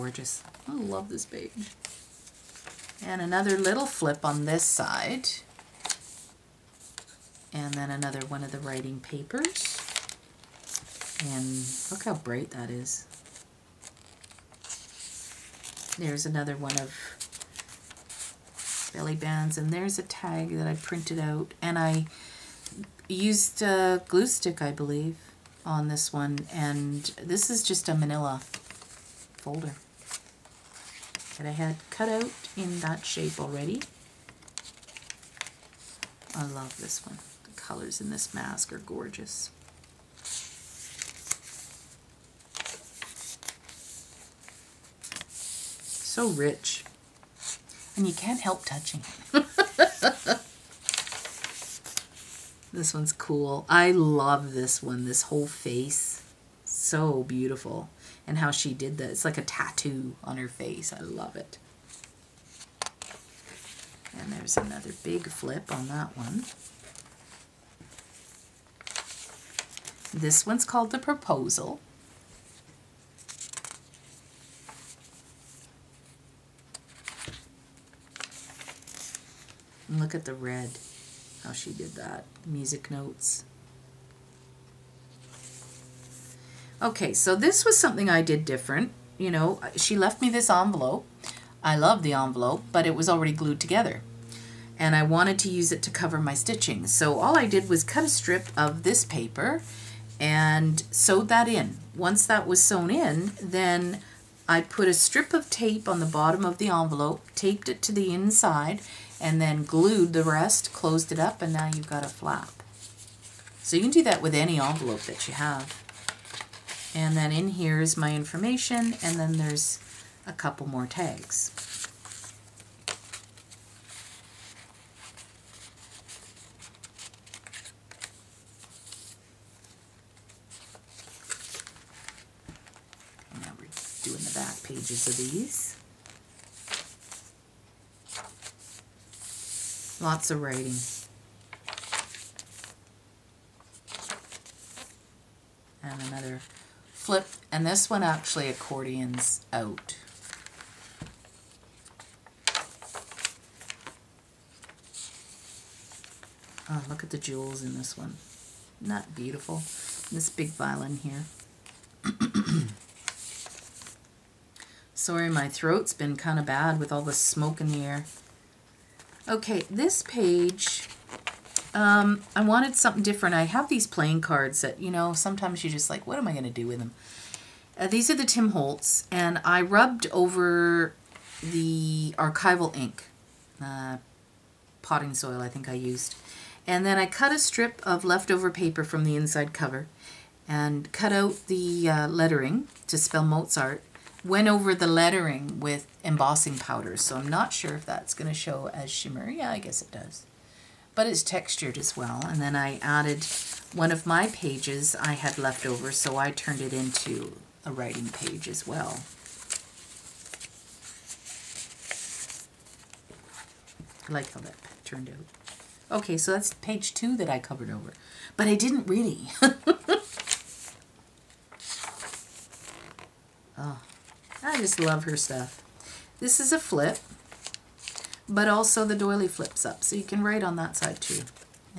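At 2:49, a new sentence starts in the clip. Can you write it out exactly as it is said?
Okay, this page, um, I wanted something different.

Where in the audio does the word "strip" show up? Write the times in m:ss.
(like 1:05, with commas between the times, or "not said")
1:38, 1:44, 3:07.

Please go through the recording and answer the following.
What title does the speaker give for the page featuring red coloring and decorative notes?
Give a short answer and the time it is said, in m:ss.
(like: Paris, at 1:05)
The Proposal, at 1:10.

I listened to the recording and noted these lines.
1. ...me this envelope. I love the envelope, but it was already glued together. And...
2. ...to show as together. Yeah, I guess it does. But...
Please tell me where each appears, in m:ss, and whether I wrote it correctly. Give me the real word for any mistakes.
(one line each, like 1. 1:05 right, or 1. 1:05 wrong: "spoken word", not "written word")
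1. 1:30 right
2. 3:18 wrong: "shimmer", not "together".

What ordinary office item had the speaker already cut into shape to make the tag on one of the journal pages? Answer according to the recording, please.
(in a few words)
manila folder.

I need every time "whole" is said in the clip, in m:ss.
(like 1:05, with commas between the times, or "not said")
0:55.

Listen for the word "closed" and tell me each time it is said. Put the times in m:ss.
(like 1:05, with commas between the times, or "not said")
1:50.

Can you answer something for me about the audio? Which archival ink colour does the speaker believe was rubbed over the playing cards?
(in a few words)
potting soil.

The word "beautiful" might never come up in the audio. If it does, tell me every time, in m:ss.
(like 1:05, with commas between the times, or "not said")
0:57, 2:39.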